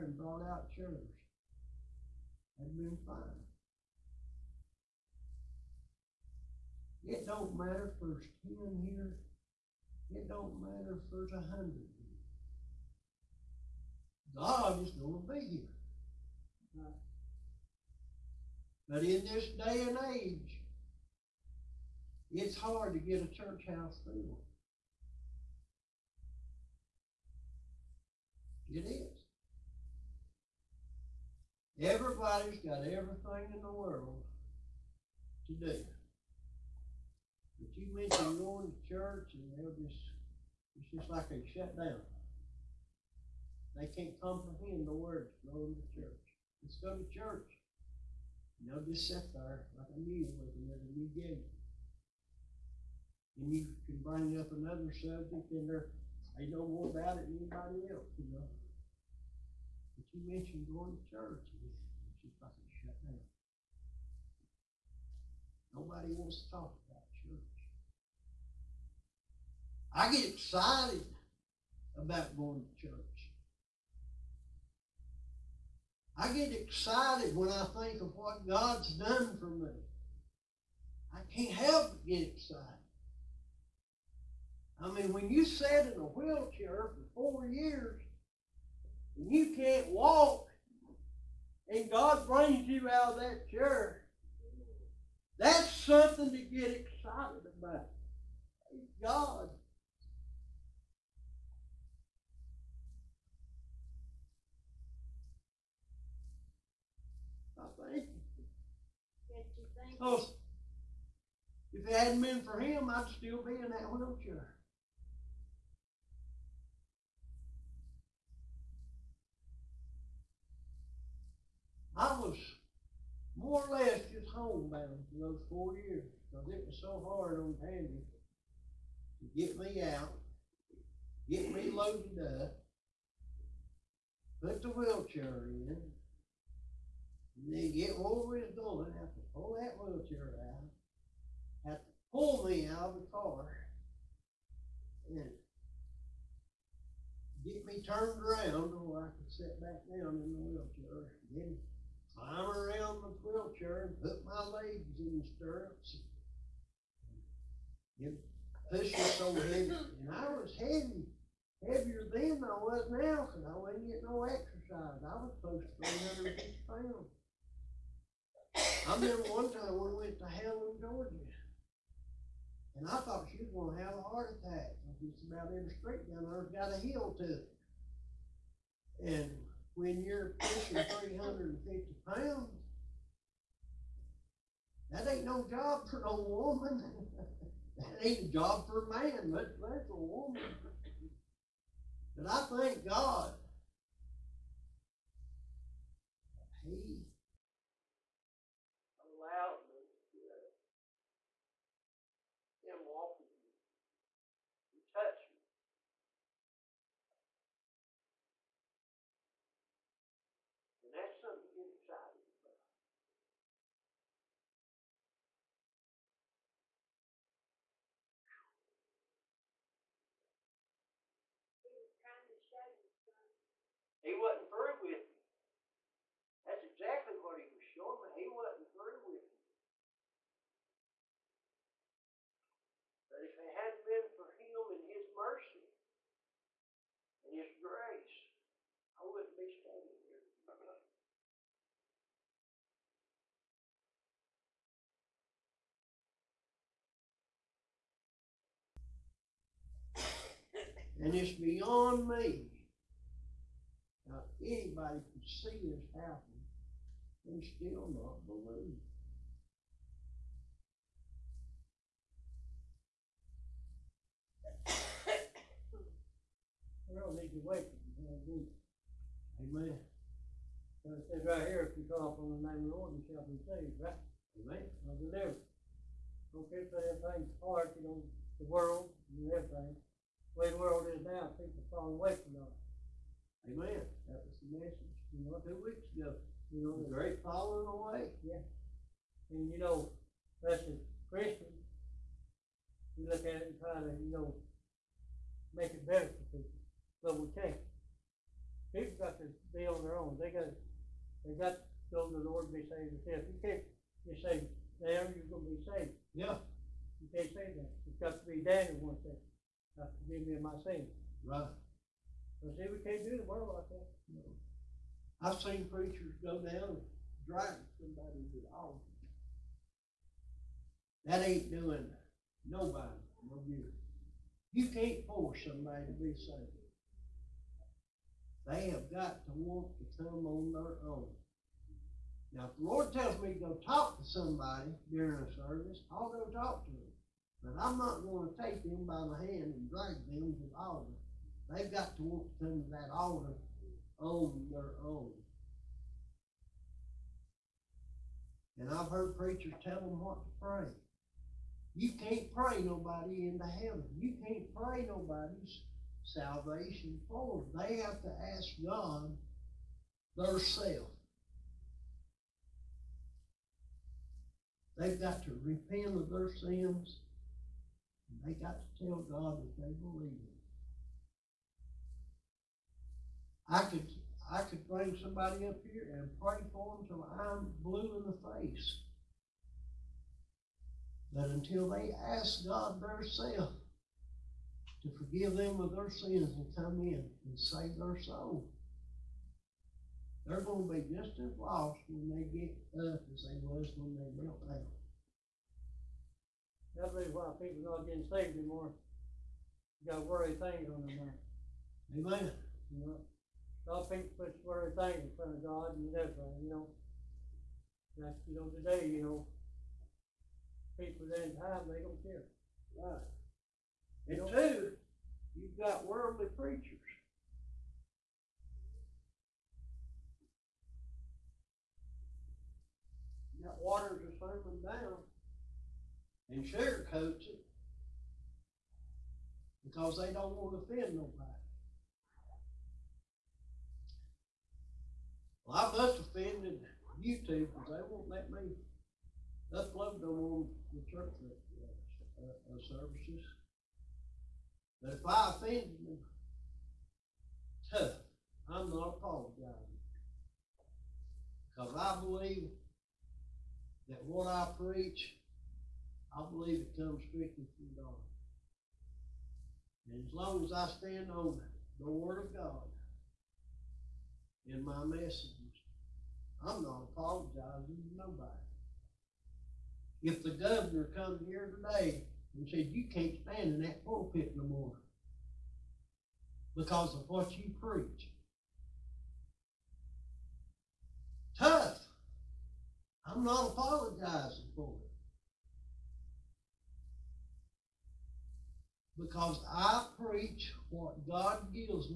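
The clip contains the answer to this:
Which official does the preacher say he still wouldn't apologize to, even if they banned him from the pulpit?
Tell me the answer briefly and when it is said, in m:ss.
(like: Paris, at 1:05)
The governor, at 7:50.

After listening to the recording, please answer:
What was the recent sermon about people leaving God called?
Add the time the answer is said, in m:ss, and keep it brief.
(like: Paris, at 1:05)
The great falling away, at 4:46.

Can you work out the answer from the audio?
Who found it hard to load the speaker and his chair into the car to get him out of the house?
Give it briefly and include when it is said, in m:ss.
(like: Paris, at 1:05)
Tandy, at 2:07.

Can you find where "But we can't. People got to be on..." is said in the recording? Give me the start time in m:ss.
4:57.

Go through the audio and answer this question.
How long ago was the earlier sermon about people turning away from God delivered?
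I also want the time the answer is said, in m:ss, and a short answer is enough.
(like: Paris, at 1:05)
2 weeks ago, at 4:45.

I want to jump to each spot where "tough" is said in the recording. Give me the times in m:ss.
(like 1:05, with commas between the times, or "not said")
7:27, 8:01.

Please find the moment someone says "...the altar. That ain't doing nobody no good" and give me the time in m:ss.
5:18.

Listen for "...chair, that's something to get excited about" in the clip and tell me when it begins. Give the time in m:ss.
1:33.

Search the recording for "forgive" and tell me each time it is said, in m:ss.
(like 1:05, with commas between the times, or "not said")
5:10, 6:24.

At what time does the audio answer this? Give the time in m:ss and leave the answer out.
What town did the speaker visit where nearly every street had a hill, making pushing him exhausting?
2:50.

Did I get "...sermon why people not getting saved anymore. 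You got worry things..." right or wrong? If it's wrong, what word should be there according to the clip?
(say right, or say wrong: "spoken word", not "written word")
wrong: "reason", not "sermon".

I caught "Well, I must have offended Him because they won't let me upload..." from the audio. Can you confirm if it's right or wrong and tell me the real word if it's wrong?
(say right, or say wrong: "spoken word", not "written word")
wrong: "YouTube", not "Him".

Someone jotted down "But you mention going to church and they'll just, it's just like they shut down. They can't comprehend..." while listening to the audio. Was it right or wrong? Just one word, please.
right.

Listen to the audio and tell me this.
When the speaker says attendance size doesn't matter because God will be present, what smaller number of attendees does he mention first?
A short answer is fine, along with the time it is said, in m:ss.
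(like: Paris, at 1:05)
10, at 0:08.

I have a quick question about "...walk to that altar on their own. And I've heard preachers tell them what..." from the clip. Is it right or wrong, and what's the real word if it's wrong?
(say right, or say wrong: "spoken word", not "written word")
right.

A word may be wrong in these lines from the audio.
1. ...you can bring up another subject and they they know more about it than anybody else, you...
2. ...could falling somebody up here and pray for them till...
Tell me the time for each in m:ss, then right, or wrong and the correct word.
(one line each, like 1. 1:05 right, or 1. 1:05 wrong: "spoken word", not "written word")
1. 0:53 right
2. 6:14 wrong: "bring", not "falling".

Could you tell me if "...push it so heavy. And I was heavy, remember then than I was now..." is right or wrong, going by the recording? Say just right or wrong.
wrong.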